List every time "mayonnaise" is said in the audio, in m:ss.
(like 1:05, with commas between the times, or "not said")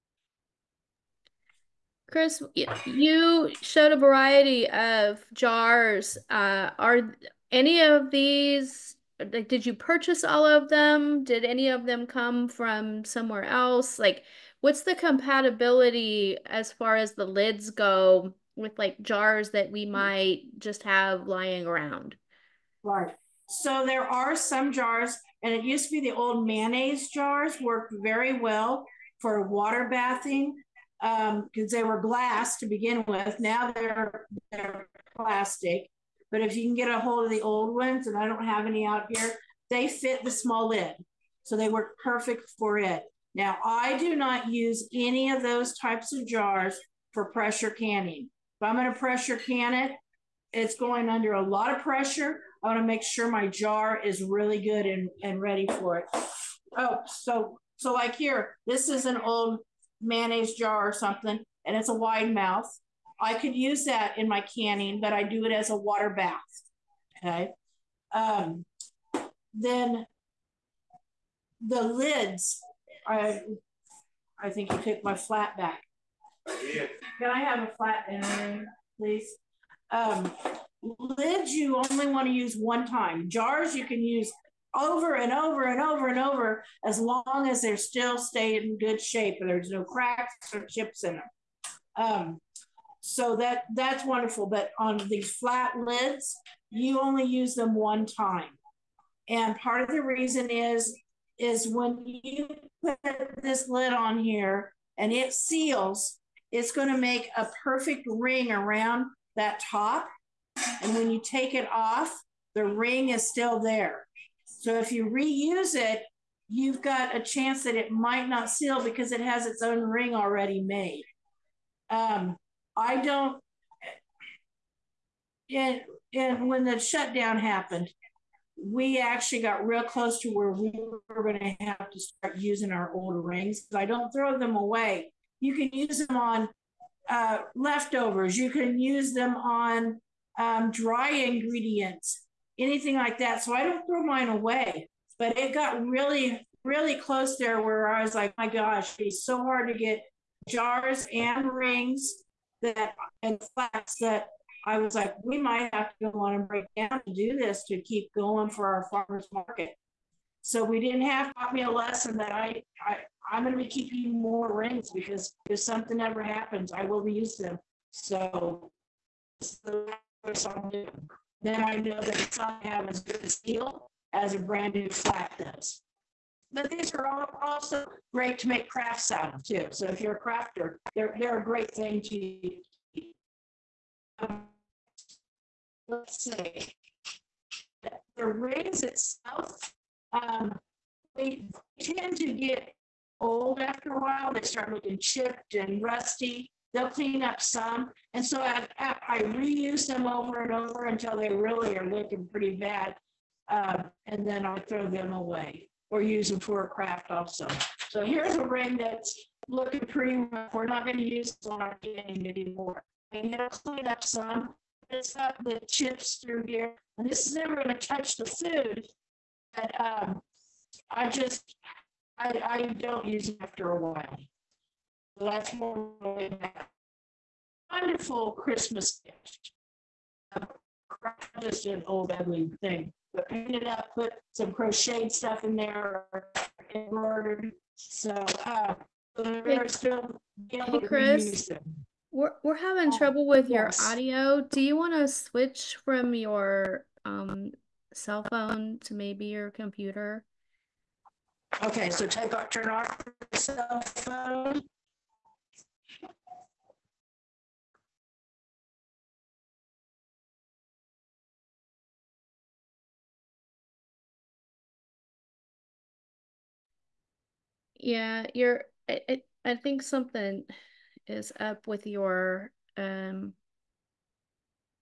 0:26, 1:00.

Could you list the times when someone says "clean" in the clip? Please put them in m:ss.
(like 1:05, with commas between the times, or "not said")
3:16, 3:33.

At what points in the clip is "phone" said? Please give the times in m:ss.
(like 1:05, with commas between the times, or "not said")
4:08, 4:13.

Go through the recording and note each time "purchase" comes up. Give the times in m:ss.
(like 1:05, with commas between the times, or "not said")
0:09.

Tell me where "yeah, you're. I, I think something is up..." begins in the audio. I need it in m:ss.
4:27.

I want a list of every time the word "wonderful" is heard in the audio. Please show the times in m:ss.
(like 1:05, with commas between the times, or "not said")
1:34, 3:47.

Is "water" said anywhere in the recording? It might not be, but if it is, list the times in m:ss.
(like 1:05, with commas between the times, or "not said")
0:29, 1:05.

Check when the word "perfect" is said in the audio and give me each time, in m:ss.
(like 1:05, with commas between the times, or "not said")
0:42, 1:47.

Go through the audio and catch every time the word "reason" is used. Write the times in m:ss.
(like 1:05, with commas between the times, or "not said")
1:40.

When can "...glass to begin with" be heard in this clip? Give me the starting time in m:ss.
0:32.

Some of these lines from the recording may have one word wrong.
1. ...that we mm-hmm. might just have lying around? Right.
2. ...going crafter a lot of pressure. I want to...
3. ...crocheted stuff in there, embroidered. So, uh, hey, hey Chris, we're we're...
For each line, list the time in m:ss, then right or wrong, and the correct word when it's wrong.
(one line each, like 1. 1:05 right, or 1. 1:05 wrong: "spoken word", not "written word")
1. 0:19 right
2. 0:50 wrong: "under", not "crafter"
3. 3:54 right.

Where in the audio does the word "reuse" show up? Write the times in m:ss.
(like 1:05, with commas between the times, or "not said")
1:55, 2:47, 3:19.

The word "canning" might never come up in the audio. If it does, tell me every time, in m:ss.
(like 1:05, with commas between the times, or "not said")
0:47, 1:04.